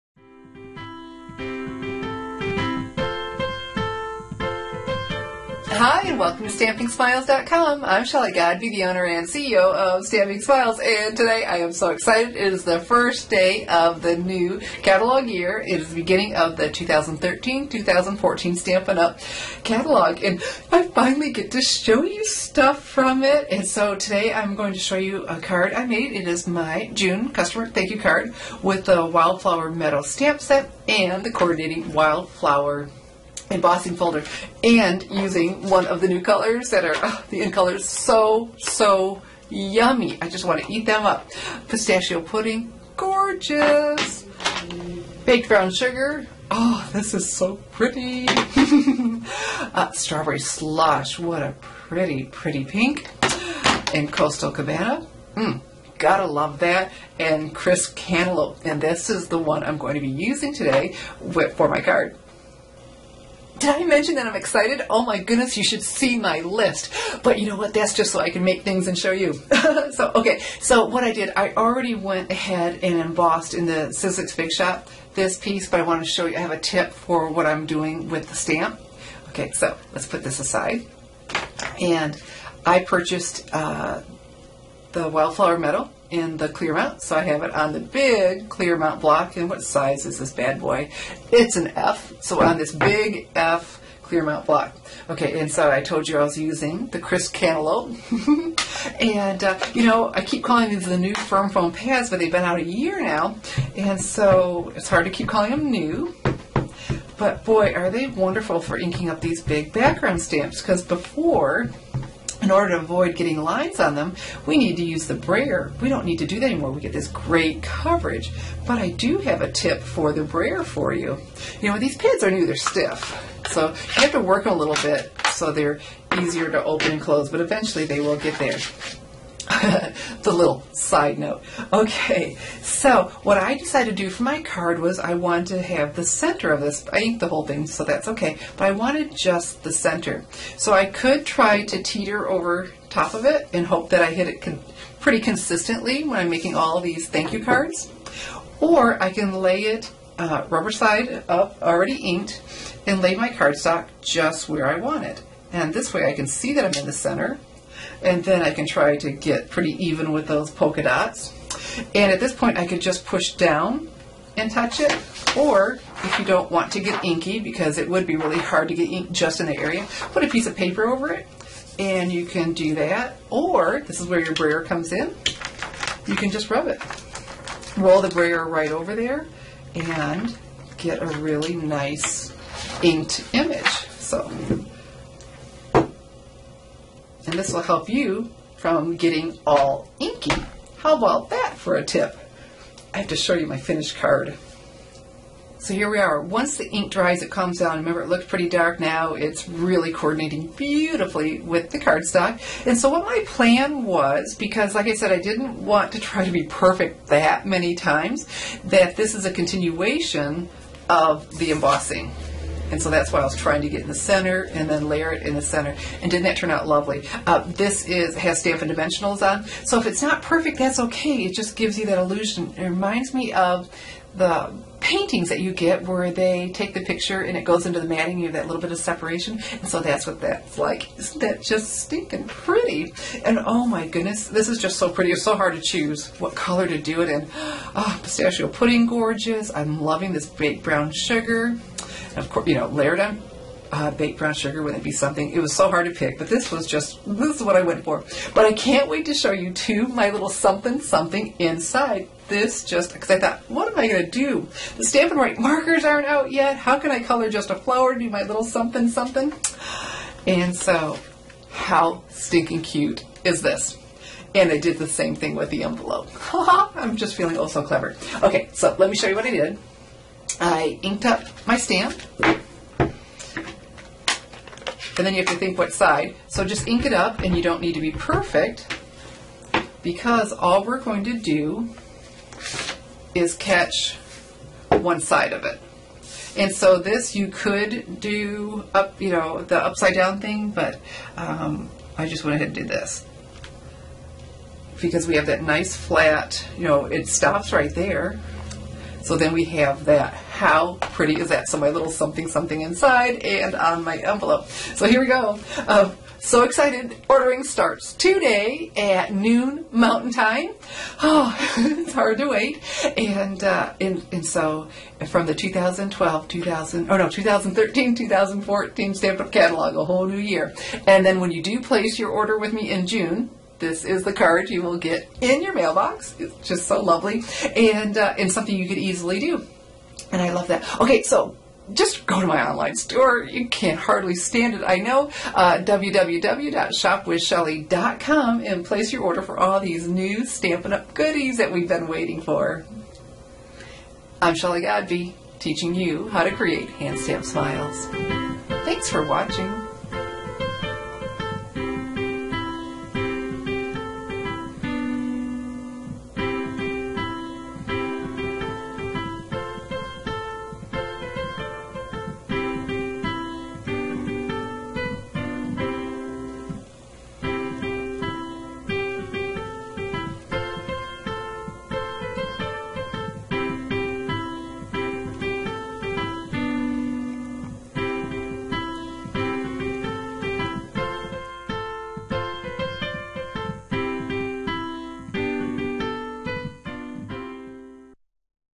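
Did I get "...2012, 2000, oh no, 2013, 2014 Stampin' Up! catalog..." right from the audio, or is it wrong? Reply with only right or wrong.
right.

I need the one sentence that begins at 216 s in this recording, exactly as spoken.
And didn't that turn out lovely?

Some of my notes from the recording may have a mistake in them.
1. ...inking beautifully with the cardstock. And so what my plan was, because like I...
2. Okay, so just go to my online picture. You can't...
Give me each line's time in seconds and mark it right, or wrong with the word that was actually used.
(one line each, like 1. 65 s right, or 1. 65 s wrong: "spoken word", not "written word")
1. 199 s wrong: "coordinating", not "inking"
2. 330 s wrong: "store", not "picture".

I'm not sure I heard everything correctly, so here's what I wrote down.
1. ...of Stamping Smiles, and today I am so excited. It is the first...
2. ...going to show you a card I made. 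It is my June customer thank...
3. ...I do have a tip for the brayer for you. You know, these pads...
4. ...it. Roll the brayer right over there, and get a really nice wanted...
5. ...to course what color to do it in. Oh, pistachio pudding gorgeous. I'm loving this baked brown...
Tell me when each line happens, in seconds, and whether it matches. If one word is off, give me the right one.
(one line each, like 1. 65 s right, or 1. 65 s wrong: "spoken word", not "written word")
1. 9 s right
2. 24 s right
3. 118 s right
4. 176 s wrong: "inked", not "wanted"
5. 235 s wrong: "choose", not "course".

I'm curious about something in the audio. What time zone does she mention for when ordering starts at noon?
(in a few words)
Mountain Time.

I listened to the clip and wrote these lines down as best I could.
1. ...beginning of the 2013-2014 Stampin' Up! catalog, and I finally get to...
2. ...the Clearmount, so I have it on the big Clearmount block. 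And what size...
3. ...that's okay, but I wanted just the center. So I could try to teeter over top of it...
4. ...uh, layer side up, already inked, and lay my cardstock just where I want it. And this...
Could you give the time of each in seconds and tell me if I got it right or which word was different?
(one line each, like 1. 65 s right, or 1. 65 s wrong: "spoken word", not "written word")
1. 15 s right
2. 86 s right
3. 137 s right
4. 150 s wrong: "rubber", not "layer".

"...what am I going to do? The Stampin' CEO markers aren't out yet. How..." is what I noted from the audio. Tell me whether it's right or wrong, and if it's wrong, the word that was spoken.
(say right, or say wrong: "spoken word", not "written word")
wrong: "Write", not "CEO".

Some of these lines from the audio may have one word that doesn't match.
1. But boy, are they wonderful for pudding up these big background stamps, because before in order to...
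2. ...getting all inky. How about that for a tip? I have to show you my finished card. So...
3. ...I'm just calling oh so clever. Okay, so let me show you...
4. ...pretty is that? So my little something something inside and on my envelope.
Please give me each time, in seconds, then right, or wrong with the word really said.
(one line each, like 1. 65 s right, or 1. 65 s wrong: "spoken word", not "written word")
1. 107 s wrong: "inking", not "pudding"
2. 188 s right
3. 266 s wrong: "feeling", not "calling"
4. 300 s right.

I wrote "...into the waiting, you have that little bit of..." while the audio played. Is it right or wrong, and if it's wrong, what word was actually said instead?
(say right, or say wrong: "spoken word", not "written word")
wrong: "matting", not "waiting".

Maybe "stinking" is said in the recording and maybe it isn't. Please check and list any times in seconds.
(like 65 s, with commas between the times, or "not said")
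231 s, 262 s.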